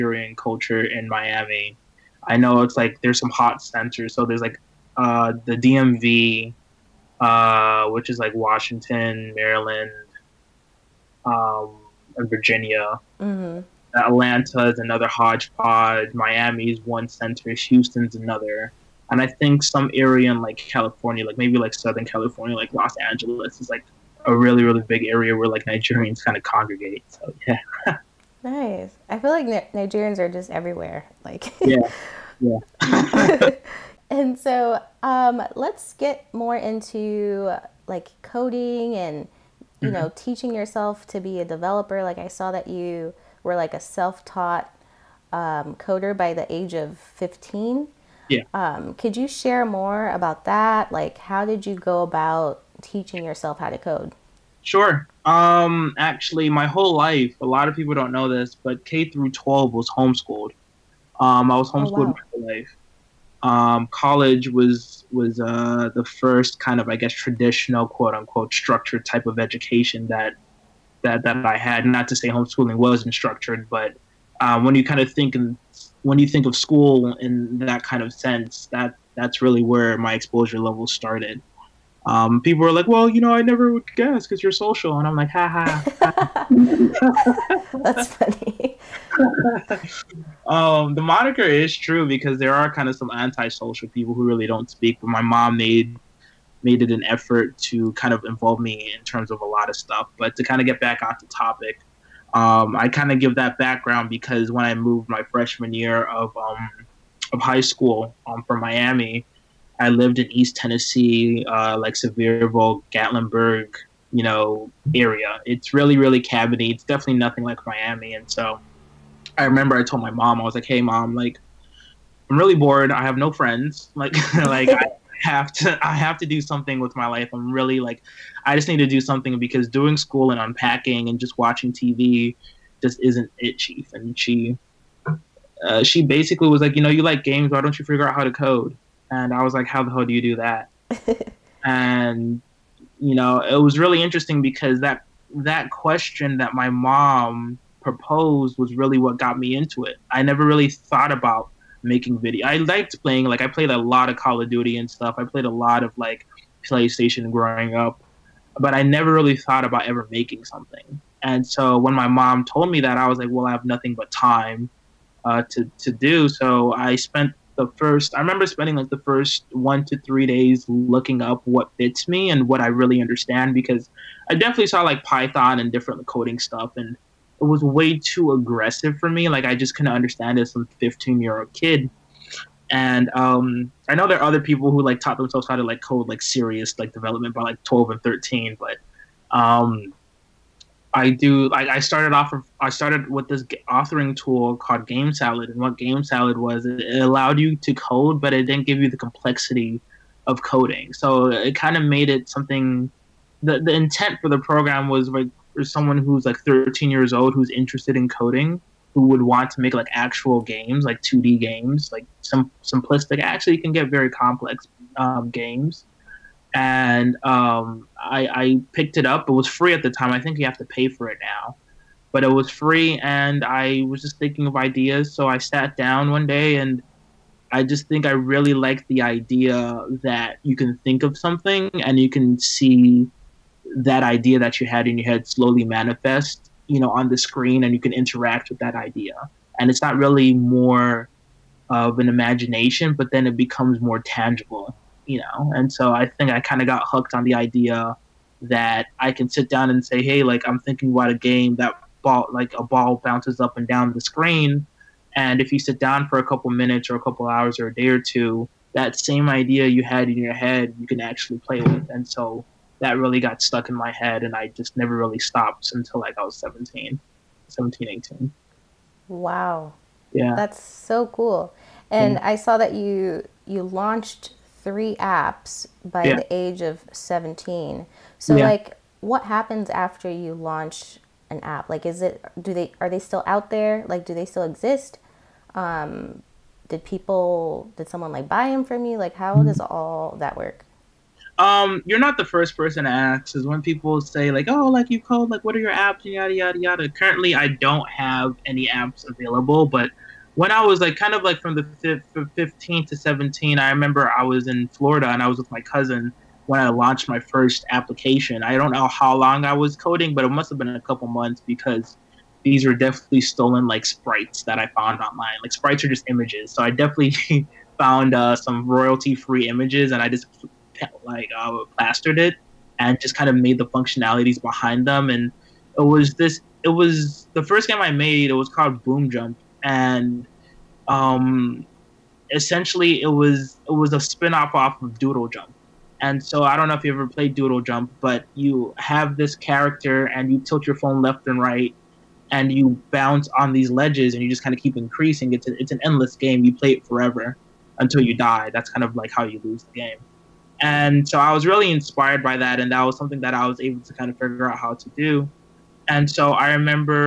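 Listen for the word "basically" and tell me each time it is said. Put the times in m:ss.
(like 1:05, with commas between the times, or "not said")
2:16.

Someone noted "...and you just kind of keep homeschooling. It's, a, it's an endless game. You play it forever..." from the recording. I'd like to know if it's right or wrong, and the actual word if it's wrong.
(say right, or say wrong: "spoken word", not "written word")
wrong: "increasing", not "homeschooling".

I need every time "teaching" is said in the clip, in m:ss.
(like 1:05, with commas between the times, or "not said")
0:40, 0:52.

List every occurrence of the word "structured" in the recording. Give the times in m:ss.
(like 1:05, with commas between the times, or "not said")
1:08, 1:13.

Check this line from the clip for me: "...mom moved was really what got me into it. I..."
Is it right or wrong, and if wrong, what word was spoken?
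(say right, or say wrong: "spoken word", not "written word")
wrong: "proposed", not "moved".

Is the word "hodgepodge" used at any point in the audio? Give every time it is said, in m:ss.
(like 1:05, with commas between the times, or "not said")
0:15.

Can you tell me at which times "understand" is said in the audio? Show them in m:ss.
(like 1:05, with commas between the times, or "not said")
2:52, 2:59.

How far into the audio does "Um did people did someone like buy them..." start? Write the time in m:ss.
4:45.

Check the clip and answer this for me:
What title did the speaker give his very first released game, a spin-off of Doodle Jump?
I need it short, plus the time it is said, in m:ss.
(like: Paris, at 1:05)
Boom Jump, at 5:28.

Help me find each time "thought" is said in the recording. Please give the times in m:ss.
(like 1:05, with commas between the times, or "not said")
2:30, 2:39.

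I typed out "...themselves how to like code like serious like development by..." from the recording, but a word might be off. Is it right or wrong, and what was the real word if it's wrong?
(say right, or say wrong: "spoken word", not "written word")
right.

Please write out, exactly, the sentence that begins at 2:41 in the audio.
And so when my mom told me that, I was like, well, I have nothing but time uh, to to do.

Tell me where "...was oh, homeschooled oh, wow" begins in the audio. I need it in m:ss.
1:01.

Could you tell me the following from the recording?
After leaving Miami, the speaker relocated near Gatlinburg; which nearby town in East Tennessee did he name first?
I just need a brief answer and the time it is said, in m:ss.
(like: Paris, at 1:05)
Sevierville, at 1:51.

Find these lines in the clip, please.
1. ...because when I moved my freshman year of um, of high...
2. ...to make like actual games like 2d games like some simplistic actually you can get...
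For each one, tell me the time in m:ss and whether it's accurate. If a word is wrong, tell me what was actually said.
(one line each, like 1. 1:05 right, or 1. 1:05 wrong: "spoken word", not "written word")
1. 1:44 right
2. 3:29 right.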